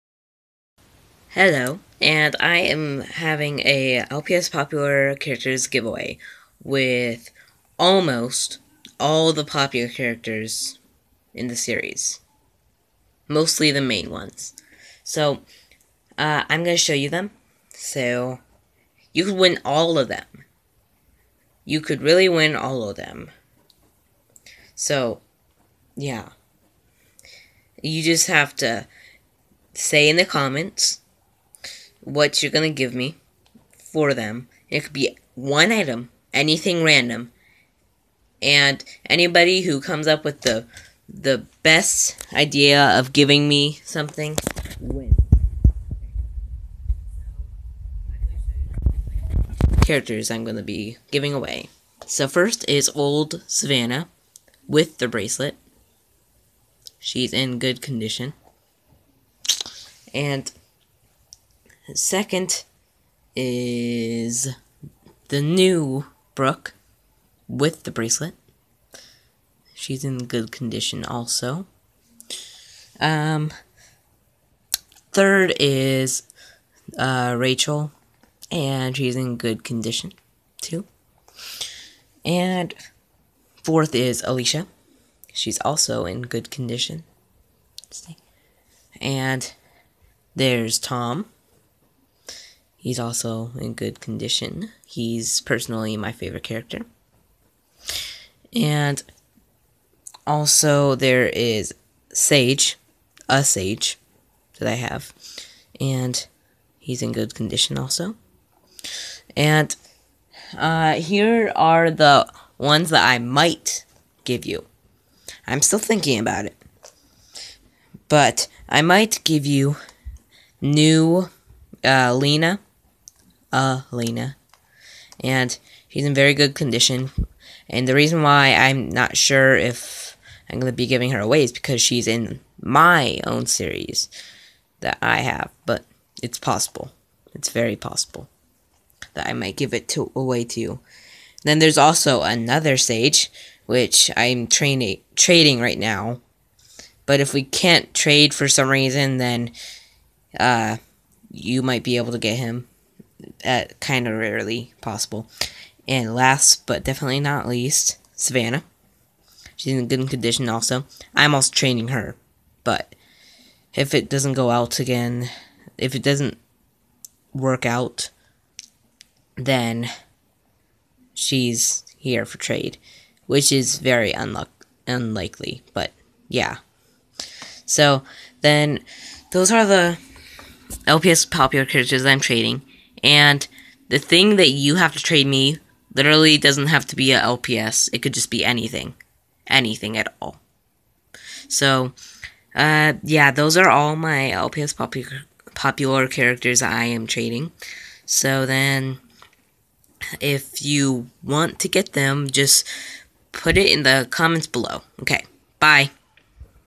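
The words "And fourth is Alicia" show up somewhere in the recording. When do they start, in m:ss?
1:22.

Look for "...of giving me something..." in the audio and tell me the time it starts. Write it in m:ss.
0:42.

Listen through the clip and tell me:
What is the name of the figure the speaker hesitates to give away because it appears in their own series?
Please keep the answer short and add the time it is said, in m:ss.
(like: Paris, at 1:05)
Elena, at 2:03.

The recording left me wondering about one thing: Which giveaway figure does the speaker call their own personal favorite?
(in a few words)
Tom.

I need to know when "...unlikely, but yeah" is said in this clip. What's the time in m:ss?
2:54.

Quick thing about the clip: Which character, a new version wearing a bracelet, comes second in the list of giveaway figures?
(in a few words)
Brooke.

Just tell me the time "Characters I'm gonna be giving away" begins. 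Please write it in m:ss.
0:49.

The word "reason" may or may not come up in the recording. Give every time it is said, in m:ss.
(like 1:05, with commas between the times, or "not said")
2:07, 2:28.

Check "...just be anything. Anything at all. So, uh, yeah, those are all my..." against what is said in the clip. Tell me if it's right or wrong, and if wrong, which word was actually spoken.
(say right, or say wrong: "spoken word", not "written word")
right.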